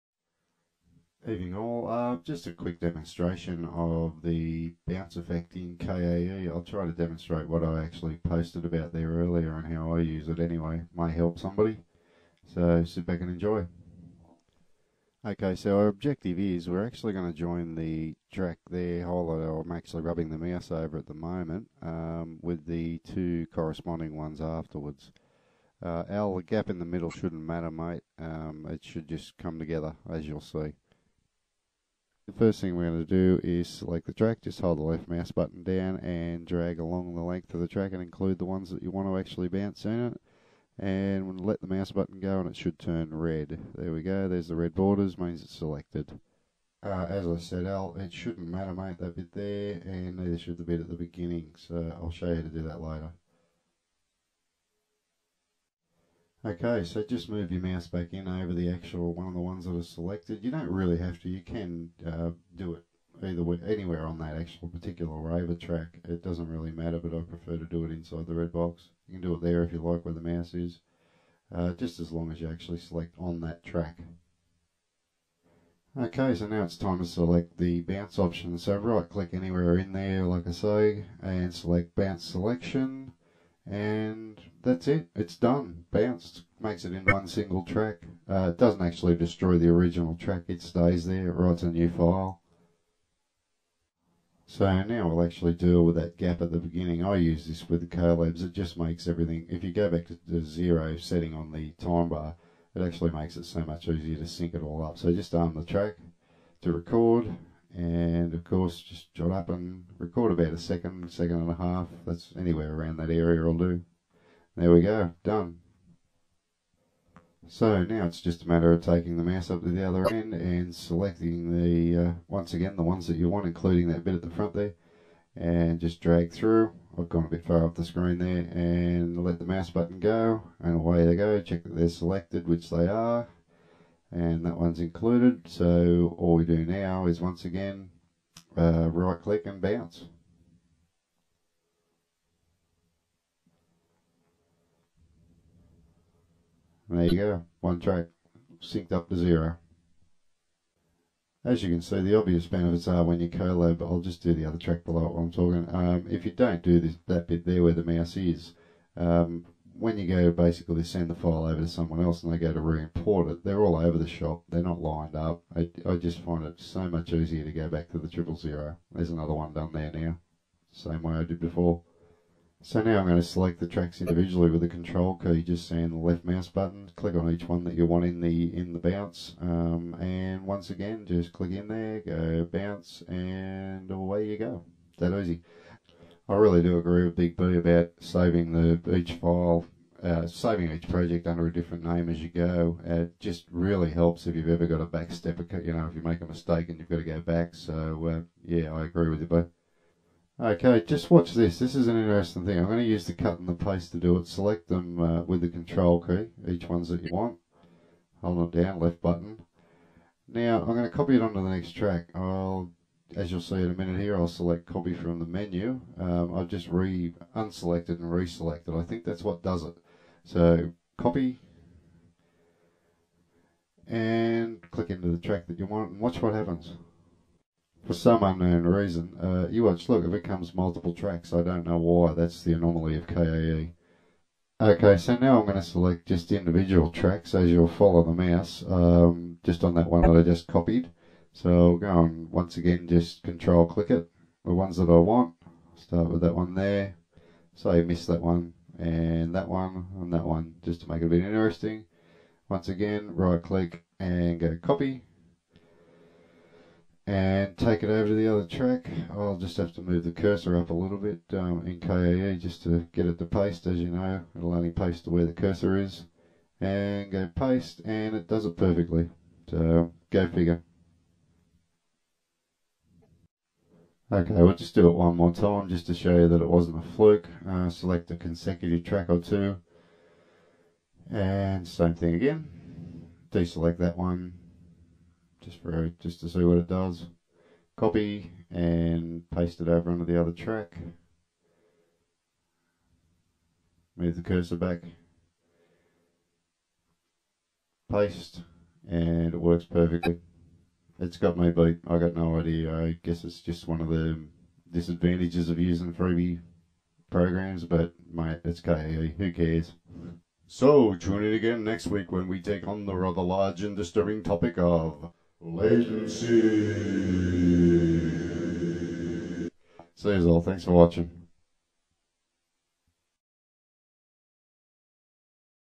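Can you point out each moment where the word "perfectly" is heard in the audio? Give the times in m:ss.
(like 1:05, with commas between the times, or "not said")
4:28, 4:59.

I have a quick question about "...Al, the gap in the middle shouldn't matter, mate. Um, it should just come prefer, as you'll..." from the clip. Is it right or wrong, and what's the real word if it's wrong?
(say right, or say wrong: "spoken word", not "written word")
wrong: "together", not "prefer".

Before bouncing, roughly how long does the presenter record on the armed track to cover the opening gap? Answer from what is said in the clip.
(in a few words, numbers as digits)
About 1.5 seconds.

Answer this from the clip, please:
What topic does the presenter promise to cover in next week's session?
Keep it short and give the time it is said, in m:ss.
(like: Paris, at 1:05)
Latency, at 5:15.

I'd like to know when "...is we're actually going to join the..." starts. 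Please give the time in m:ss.
0:16.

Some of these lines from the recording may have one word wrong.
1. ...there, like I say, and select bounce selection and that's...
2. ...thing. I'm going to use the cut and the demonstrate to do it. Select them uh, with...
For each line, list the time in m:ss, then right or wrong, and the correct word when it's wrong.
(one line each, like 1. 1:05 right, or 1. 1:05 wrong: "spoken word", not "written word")
1. 1:19 right
2. 3:22 wrong: "paste", not "demonstrate".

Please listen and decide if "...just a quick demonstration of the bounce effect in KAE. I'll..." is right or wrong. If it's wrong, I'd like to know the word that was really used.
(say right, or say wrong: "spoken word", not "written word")
right.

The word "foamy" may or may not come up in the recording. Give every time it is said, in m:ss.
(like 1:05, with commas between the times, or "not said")
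not said.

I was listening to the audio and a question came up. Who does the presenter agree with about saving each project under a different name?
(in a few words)
Big B.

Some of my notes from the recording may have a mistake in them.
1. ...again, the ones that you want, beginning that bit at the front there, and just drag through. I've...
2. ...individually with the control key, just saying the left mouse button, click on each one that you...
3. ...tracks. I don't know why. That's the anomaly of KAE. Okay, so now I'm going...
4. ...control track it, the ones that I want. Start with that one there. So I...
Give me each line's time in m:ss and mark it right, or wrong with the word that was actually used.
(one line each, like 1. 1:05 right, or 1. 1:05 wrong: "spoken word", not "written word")
1. 2:02 wrong: "including", not "beginning"
2. 2:54 right
3. 3:50 right
4. 4:03 wrong: "click", not "track".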